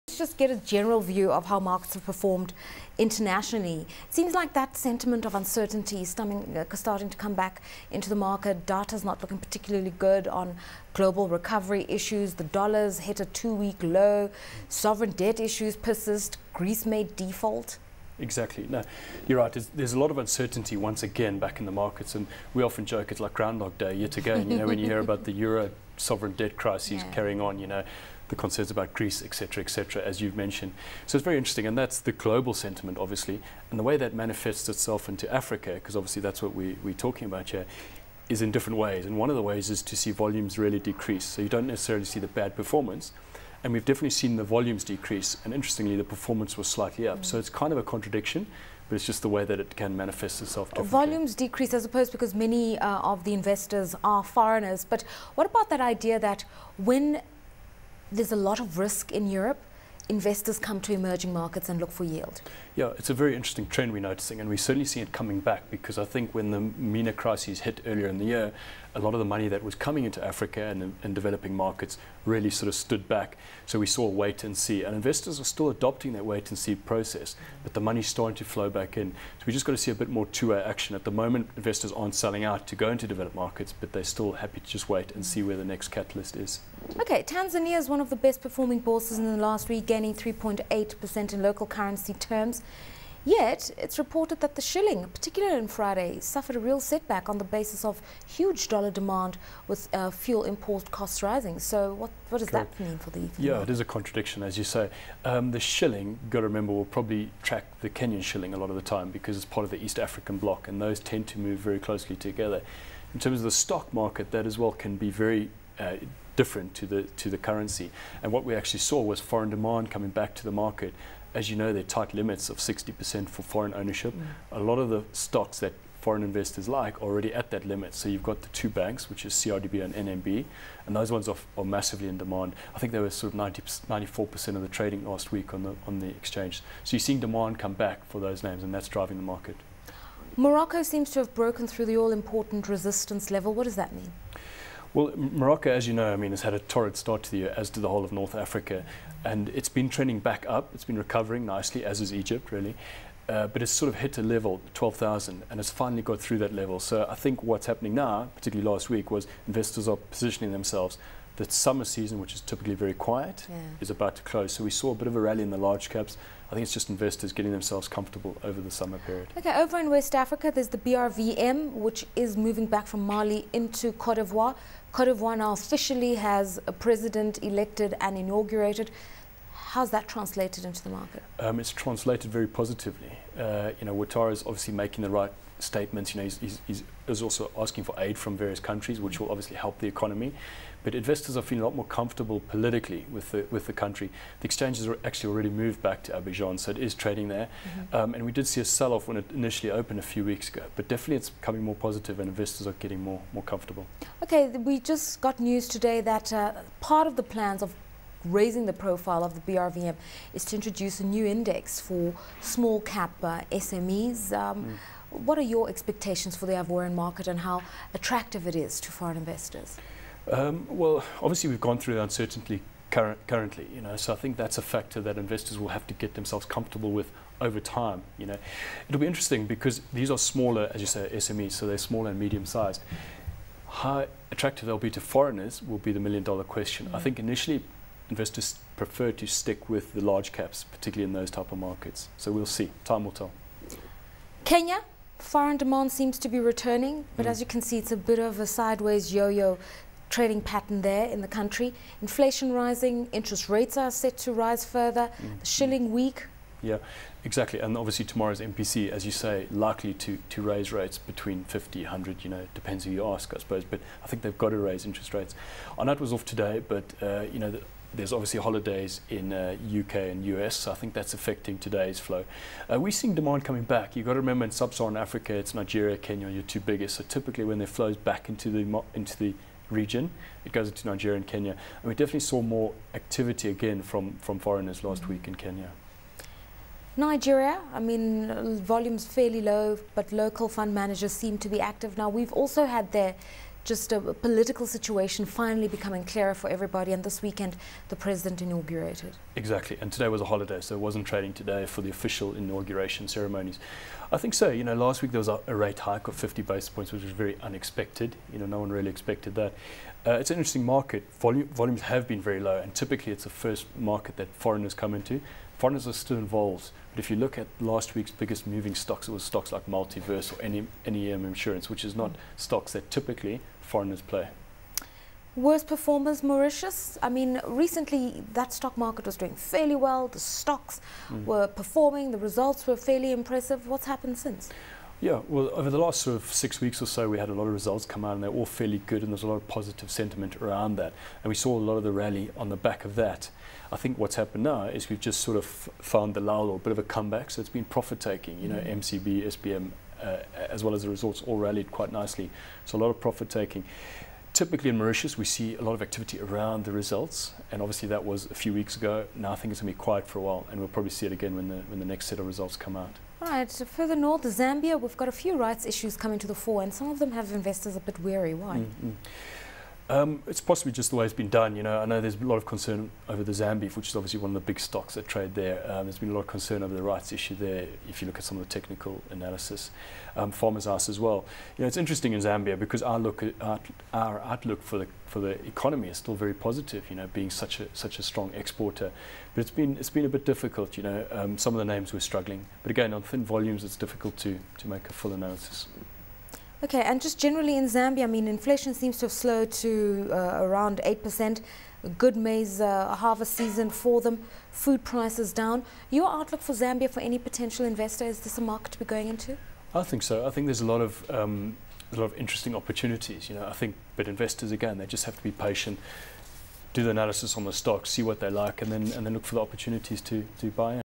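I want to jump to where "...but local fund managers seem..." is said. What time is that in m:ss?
4:49.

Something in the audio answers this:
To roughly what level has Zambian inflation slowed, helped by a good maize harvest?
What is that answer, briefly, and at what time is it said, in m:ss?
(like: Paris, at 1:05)
8%, at 6:40.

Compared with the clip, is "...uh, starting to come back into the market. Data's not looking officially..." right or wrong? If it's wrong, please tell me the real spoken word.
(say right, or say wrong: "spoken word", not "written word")
wrong: "particularly", not "officially".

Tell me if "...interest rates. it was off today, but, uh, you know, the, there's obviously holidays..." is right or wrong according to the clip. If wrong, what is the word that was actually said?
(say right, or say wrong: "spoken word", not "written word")
right.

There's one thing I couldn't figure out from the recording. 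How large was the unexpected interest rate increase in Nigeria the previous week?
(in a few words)
50 basis points.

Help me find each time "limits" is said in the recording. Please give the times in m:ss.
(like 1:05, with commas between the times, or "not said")
2:02, 2:07.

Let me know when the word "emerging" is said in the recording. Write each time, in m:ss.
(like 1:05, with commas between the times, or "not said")
1:00.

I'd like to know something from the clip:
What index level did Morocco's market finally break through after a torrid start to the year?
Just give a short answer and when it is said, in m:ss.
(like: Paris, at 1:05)
12,000, at 2:34.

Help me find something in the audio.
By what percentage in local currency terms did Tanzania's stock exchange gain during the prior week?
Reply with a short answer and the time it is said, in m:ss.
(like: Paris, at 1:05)
3.8%, at 1:30.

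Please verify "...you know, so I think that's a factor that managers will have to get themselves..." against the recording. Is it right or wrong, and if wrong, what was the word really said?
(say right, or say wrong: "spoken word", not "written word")
wrong: "investors", not "managers".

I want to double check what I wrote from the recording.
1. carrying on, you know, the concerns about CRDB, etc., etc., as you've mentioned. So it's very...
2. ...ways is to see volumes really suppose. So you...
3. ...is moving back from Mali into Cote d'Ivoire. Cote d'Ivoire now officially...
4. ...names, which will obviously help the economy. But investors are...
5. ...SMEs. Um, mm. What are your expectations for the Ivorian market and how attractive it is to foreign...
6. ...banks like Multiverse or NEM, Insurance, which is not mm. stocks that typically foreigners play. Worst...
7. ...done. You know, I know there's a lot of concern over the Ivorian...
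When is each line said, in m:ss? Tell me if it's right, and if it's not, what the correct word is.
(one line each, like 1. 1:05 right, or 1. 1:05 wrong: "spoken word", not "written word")
1. 0:27 wrong: "Greece", not "CRDB"
2. 0:39 wrong: "decrease", not "suppose"
3. 2:52 right
4. 3:08 wrong: "countries", not "names"
5. 3:33 right
6. 5:19 wrong: "stocks", not "banks"
7. 6:11 wrong: "Zambeef", not "Ivorian".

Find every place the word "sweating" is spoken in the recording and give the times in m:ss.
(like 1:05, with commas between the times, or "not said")
not said.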